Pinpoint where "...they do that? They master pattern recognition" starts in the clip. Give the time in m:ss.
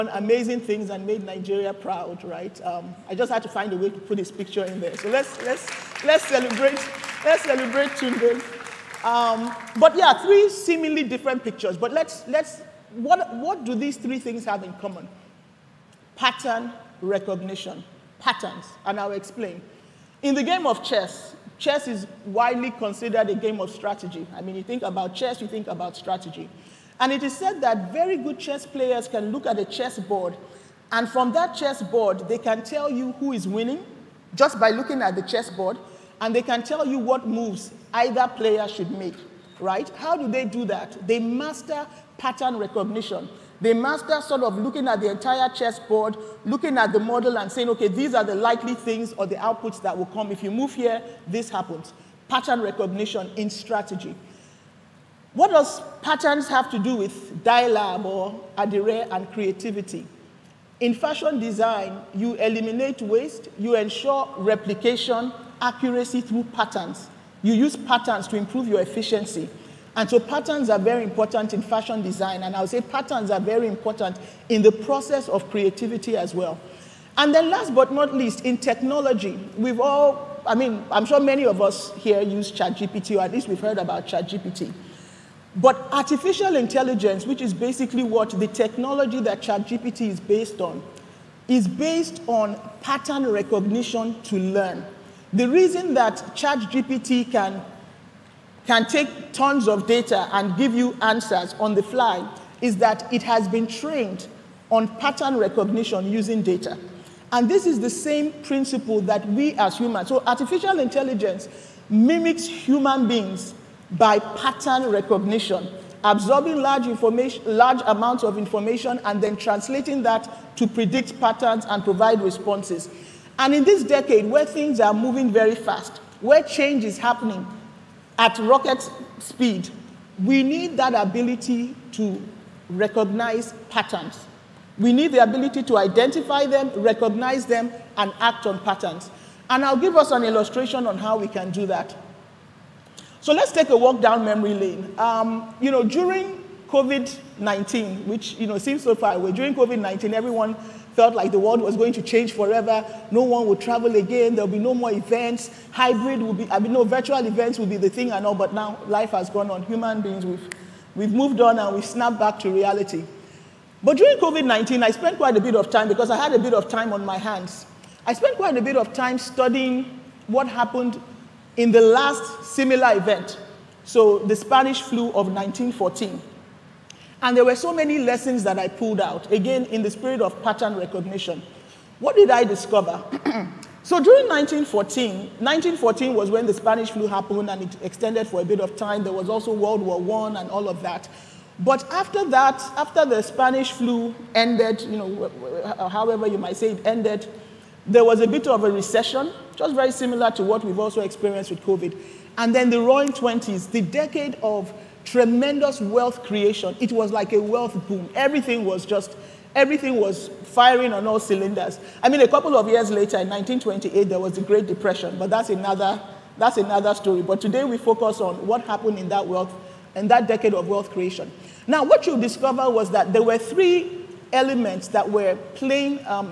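0:40.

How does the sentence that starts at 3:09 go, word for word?
There was also World War I and all of that.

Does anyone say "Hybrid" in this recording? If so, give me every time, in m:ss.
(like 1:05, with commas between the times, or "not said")
2:35.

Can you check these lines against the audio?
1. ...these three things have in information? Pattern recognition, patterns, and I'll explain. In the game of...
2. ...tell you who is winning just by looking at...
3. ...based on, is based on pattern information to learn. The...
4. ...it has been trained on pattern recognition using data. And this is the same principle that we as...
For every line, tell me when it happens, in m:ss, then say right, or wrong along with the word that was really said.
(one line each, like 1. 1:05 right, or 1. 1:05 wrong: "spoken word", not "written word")
1. 0:13 wrong: "common", not "information"
2. 0:32 right
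3. 1:30 wrong: "recognition", not "information"
4. 1:43 right.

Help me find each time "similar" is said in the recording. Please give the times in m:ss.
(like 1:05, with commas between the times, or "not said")
2:52, 3:19.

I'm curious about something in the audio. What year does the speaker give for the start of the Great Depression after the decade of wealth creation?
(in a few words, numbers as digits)
1928.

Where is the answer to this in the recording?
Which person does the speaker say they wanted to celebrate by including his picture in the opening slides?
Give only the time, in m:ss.
0:07.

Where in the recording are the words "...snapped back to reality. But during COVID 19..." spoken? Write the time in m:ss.
2:41.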